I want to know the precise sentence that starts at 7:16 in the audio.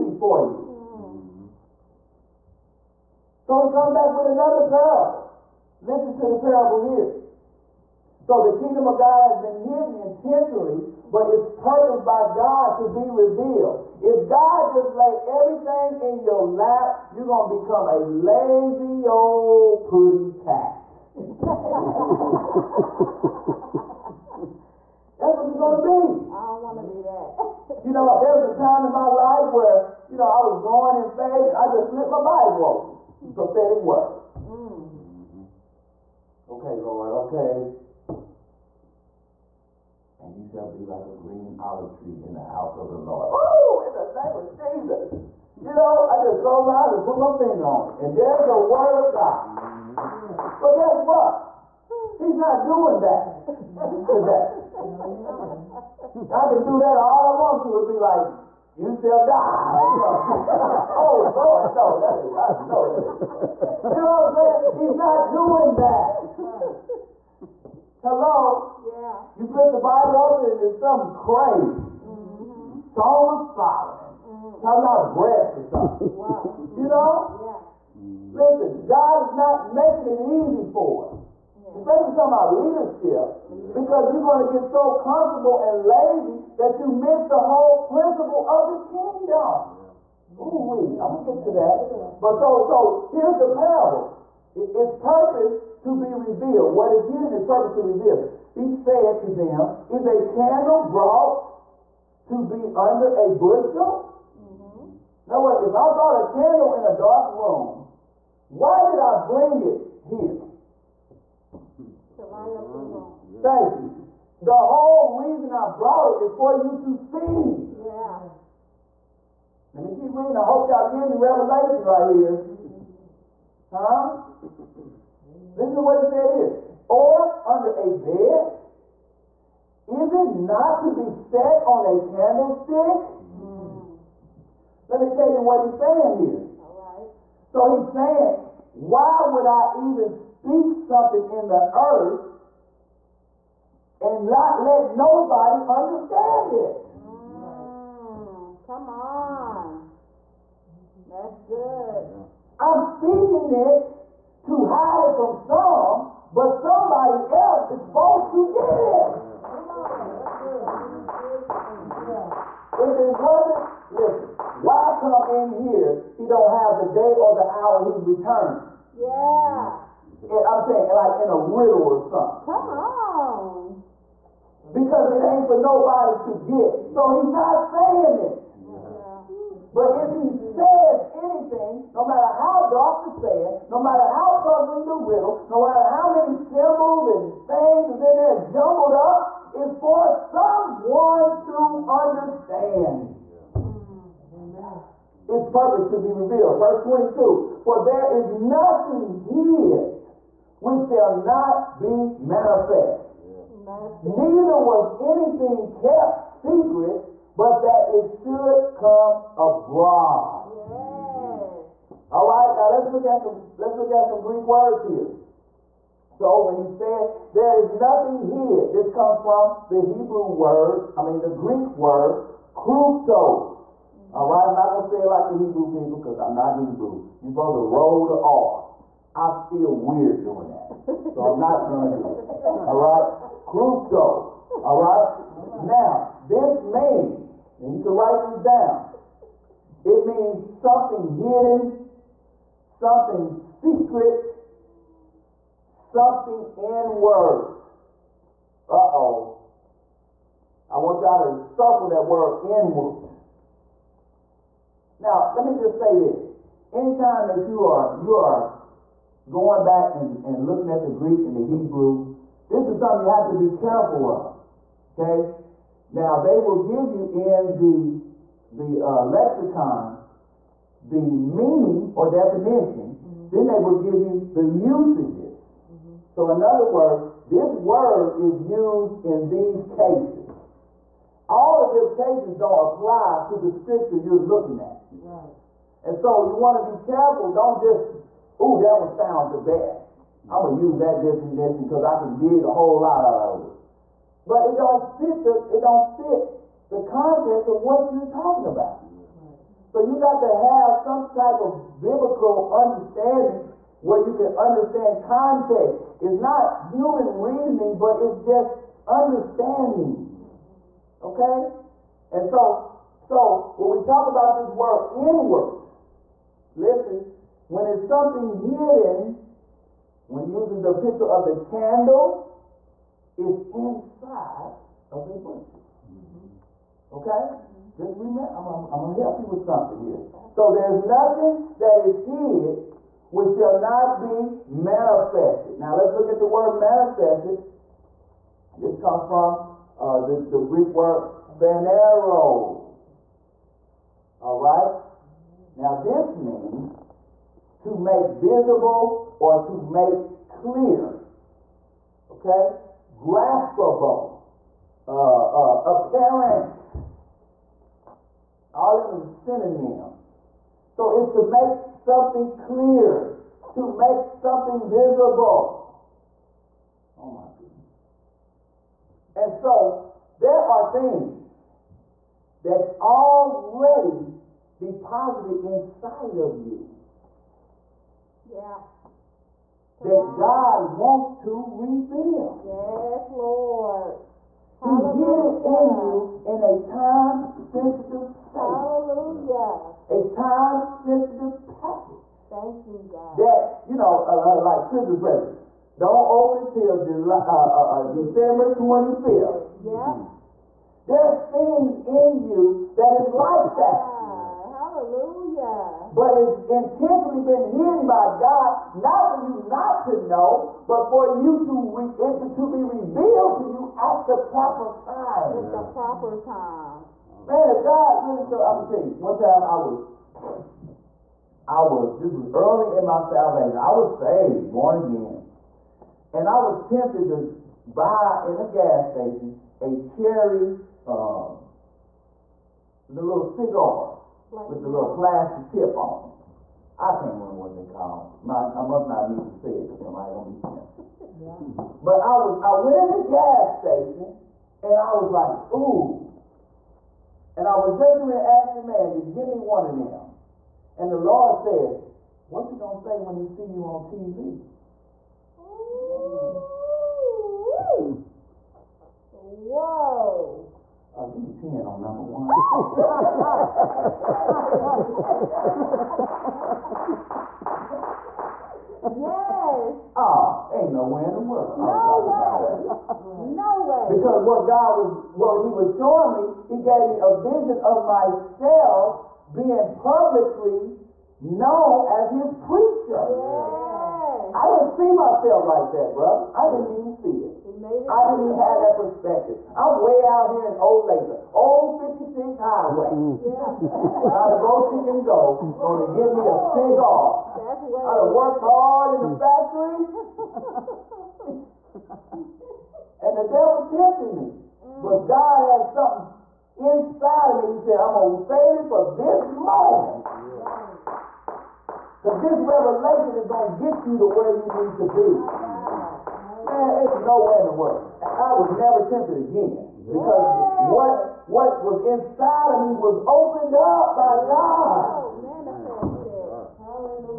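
I can't remember what they call.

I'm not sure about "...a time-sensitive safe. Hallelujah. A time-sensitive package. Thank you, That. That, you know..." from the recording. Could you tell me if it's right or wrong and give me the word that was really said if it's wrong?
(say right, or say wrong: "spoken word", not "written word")
wrong: "God", not "That".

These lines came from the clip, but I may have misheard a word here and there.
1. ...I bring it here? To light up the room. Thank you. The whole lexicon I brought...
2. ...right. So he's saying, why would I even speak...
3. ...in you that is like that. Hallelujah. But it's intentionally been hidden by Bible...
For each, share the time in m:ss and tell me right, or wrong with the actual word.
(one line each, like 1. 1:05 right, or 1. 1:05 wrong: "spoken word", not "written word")
1. 1:49 wrong: "reason", not "lexicon"
2. 2:16 right
3. 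6:41 wrong: "God", not "Bible".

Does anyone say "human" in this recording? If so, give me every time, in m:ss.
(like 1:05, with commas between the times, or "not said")
5:06.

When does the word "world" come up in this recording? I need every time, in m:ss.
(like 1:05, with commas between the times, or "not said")
7:51, 8:37.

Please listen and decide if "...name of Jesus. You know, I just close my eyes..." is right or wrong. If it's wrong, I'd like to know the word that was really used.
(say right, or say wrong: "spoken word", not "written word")
right.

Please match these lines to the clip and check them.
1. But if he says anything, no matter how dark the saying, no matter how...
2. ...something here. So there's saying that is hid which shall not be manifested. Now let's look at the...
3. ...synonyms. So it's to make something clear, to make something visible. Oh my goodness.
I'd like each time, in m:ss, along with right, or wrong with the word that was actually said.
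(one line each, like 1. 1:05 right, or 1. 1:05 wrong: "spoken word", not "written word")
1. 2:59 right
2. 5:29 wrong: "nothing", not "saying"
3. 5:59 right.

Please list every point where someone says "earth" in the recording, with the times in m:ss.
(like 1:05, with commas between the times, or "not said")
2:21.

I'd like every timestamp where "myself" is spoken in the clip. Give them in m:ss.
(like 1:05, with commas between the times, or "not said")
7:57, 8:04.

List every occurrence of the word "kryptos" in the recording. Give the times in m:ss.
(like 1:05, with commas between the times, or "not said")
3:42, 3:53.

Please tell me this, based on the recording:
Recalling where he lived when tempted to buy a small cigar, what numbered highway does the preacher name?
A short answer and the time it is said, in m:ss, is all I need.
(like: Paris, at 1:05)
Old 56 Highway, at 8:11.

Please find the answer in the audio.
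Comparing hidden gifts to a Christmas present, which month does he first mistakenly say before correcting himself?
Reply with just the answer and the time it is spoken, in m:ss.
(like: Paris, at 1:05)
July, at 6:36.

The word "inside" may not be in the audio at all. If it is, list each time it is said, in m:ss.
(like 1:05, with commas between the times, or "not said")
5:23, 6:15, 8:26, 8:41.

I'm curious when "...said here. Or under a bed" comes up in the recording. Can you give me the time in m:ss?
2:06.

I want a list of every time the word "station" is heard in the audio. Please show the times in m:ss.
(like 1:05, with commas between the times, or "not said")
7:08, 7:23.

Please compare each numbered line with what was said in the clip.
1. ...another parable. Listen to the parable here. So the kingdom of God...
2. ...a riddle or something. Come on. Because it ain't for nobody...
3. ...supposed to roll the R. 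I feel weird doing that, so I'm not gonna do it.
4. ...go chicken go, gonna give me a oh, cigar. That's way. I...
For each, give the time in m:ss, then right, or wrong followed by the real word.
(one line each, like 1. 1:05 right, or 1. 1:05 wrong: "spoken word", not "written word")
1. 0:04 right
2. 2:51 right
3. 3:47 right
4. 8:14 right.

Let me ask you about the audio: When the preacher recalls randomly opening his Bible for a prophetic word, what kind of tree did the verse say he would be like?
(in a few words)
green olive tree.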